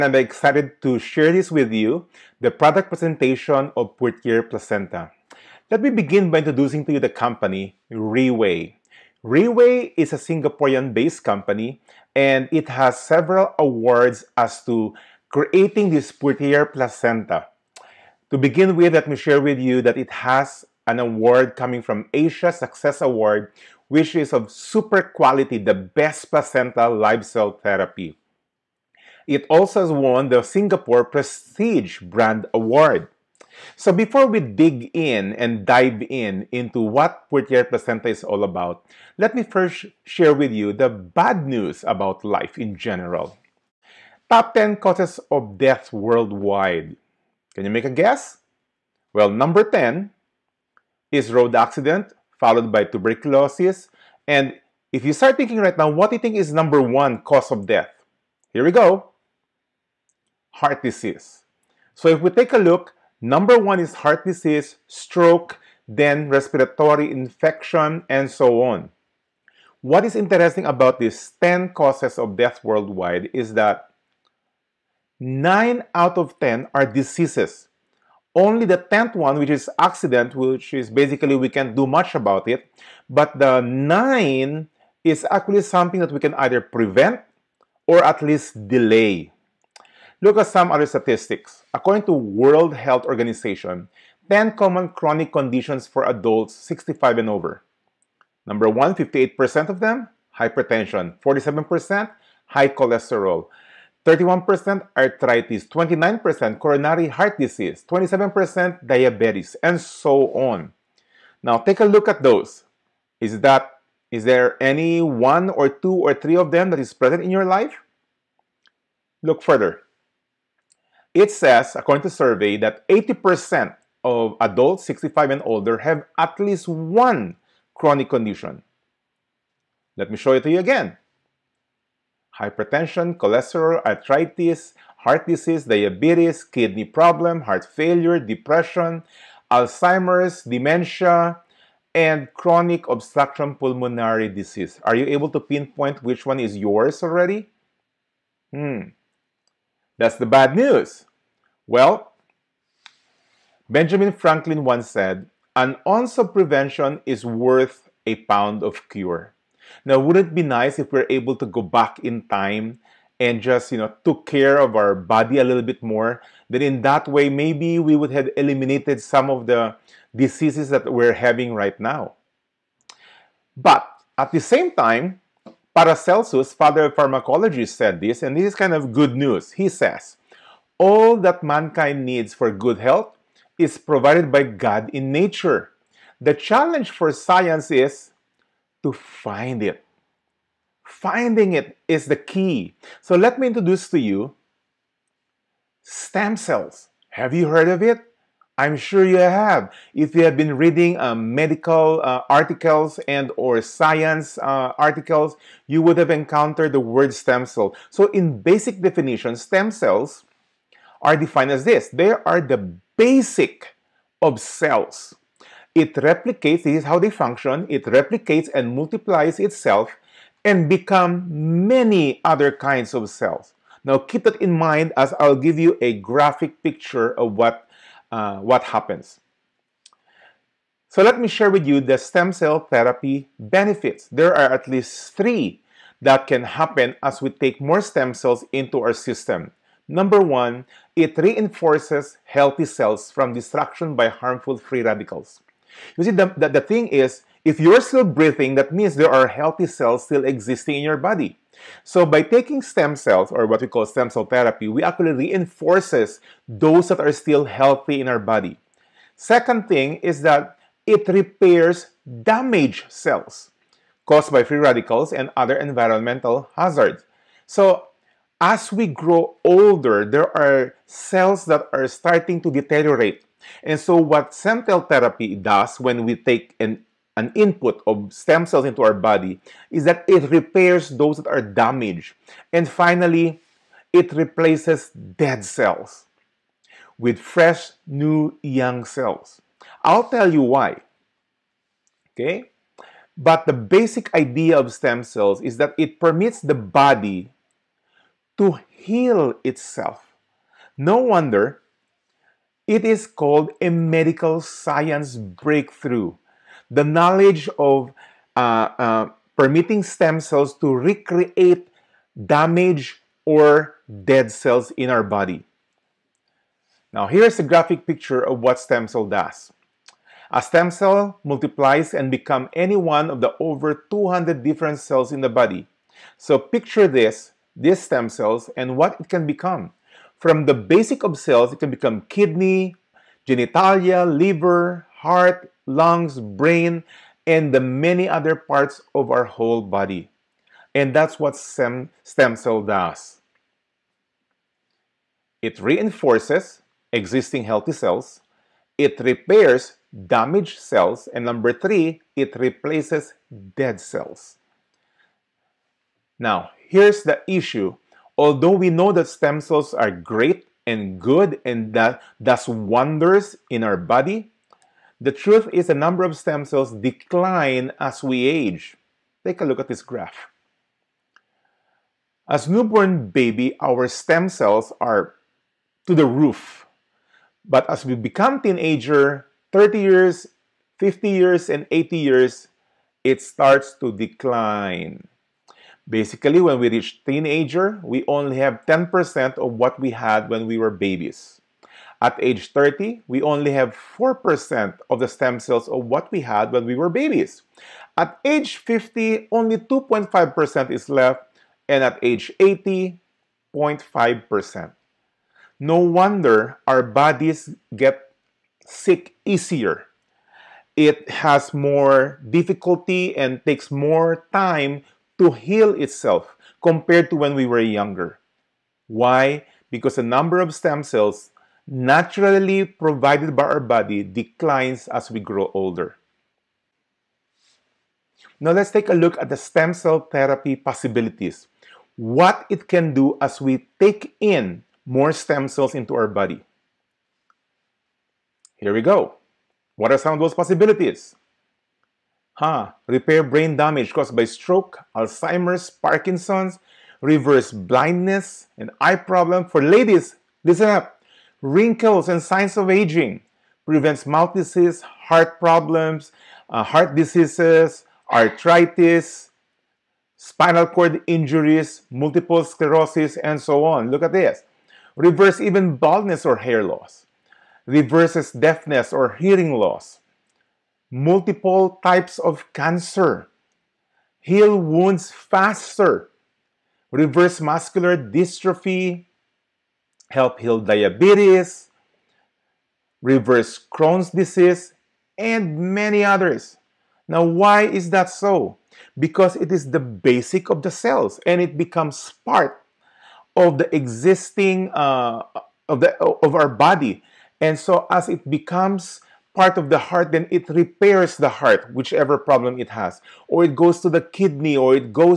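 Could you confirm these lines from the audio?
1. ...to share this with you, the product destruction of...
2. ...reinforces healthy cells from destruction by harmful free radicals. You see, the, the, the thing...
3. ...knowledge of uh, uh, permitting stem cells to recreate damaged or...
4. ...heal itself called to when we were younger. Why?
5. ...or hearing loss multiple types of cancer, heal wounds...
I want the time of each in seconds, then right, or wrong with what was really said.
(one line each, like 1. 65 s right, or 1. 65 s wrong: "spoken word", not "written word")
1. 0 s wrong: "presentation", not "destruction"
2. 241 s right
3. 306 s right
4. 415 s wrong: "compared", not "called"
5. 468 s right.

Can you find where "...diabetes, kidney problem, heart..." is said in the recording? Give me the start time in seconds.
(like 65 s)
135 s.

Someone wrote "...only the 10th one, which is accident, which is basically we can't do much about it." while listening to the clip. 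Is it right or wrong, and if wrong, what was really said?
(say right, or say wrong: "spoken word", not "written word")
right.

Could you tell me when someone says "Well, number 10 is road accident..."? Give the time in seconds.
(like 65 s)
49 s.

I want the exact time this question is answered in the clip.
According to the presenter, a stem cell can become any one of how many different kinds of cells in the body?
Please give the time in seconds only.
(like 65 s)
323 s.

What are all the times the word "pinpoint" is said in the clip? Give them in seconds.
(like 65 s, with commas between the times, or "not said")
145 s.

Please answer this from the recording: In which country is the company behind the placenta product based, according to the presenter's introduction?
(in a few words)
Singapore.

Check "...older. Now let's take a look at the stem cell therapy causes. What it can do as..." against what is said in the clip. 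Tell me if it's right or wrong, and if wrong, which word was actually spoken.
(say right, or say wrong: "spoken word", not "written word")
wrong: "possibilities", not "causes".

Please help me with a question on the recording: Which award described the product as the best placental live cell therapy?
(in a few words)
Asia Success Award.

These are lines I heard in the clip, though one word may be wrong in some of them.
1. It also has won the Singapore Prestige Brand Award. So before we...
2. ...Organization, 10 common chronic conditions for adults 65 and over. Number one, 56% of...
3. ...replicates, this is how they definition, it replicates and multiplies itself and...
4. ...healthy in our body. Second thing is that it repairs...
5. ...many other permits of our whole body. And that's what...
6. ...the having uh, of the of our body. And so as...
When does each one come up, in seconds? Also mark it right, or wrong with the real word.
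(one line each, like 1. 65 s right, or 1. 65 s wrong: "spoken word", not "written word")
1. 29 s right
2. 93 s wrong: "58", not "56"
3. 215 s wrong: "function", not "definition"
4. 257 s right
5. 337 s wrong: "parts", not "permits"
6. 493 s wrong: "existing", not "having".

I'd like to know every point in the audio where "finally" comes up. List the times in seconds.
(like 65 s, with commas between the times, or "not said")
282 s.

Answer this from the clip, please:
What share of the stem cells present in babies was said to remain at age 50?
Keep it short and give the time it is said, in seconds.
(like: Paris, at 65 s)
2.5%, at 399 s.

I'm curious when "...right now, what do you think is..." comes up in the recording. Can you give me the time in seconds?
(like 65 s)
55 s.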